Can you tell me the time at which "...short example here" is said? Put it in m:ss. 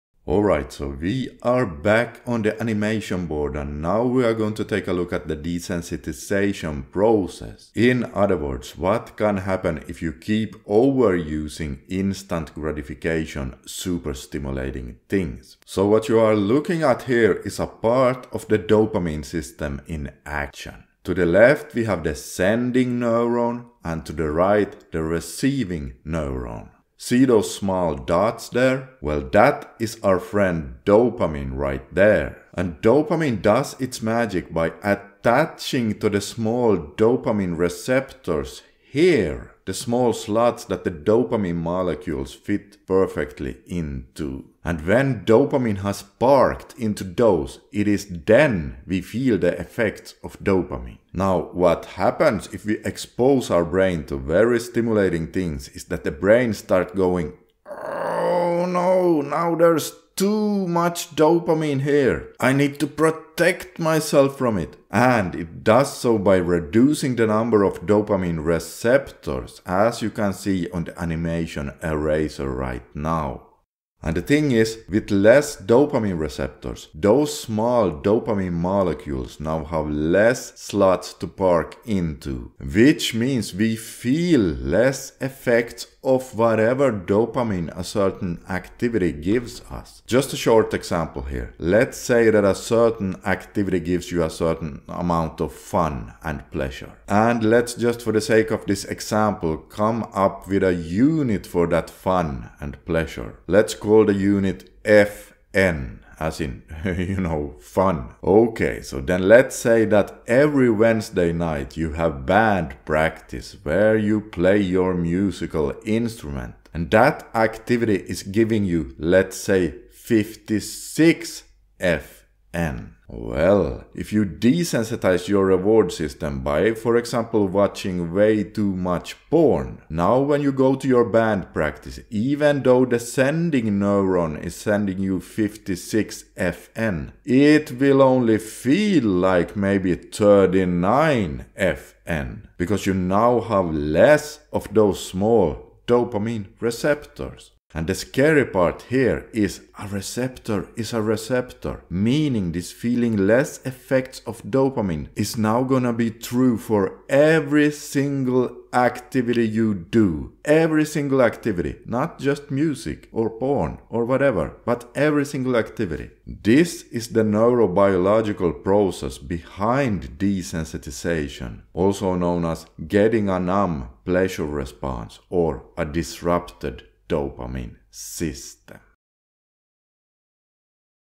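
1:30.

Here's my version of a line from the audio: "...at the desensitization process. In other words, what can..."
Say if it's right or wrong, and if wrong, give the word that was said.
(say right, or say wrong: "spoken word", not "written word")
right.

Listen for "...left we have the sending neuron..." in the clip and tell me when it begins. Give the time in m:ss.
0:21.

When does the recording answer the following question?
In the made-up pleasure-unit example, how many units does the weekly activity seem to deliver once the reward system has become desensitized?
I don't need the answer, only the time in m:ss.
2:19.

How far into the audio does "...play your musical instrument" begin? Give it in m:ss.
1:54.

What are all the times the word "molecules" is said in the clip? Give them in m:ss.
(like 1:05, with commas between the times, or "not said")
0:41, 1:18.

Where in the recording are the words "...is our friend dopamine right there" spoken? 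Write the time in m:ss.
0:29.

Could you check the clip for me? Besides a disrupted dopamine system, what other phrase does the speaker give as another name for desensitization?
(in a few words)
numb pleasure response.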